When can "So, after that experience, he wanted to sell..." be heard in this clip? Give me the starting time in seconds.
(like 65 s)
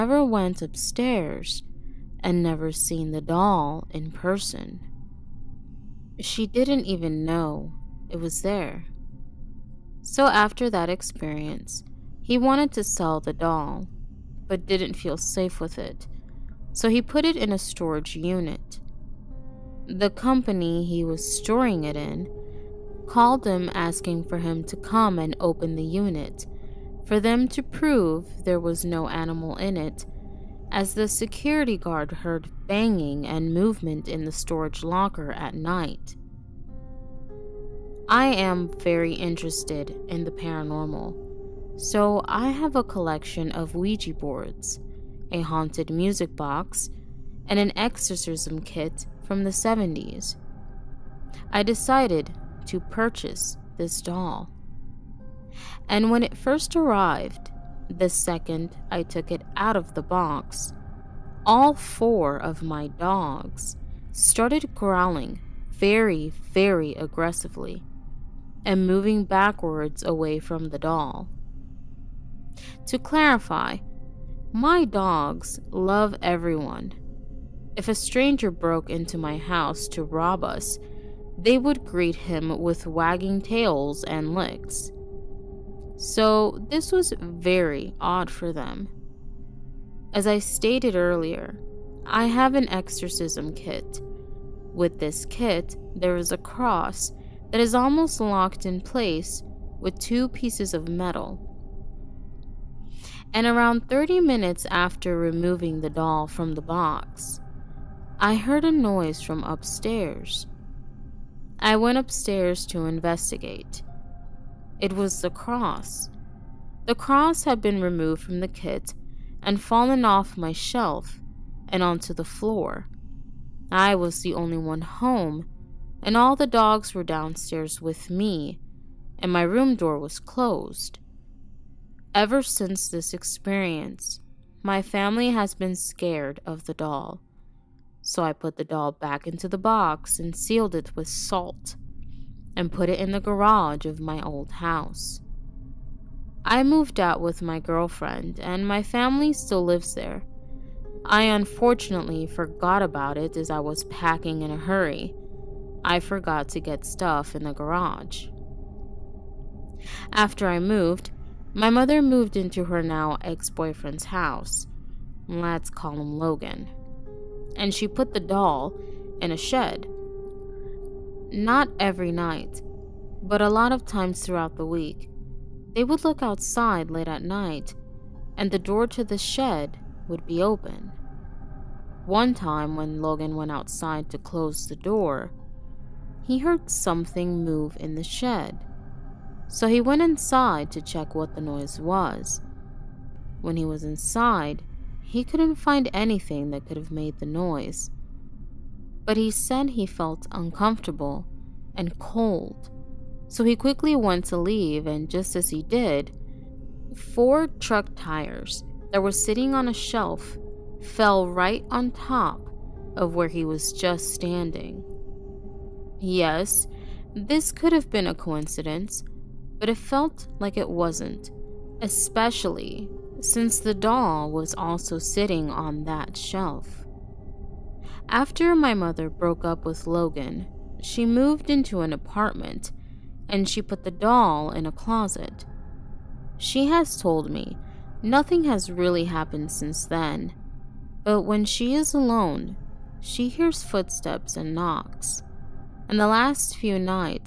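10 s.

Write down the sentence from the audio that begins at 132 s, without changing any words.
Ever since this experience, my family has been scared of the doll.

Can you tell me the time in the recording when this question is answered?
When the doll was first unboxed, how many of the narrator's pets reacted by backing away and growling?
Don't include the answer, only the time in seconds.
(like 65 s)
61 s.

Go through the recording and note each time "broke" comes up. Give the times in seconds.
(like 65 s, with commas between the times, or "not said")
78 s, 229 s.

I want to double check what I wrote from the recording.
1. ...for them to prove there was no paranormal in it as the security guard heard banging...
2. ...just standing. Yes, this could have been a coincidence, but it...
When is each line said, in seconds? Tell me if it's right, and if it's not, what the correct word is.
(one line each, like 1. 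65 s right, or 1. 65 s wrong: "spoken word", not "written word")
1. 27 s wrong: "animal", not "paranormal"
2. 213 s right.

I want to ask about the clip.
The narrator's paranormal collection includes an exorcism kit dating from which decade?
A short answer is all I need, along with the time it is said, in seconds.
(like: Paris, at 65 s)
the 70s, at 49 s.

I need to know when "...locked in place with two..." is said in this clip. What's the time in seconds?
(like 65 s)
98 s.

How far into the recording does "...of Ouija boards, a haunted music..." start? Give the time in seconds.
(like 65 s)
43 s.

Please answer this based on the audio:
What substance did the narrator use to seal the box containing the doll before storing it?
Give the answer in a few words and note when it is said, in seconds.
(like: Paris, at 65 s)
salt, at 141 s.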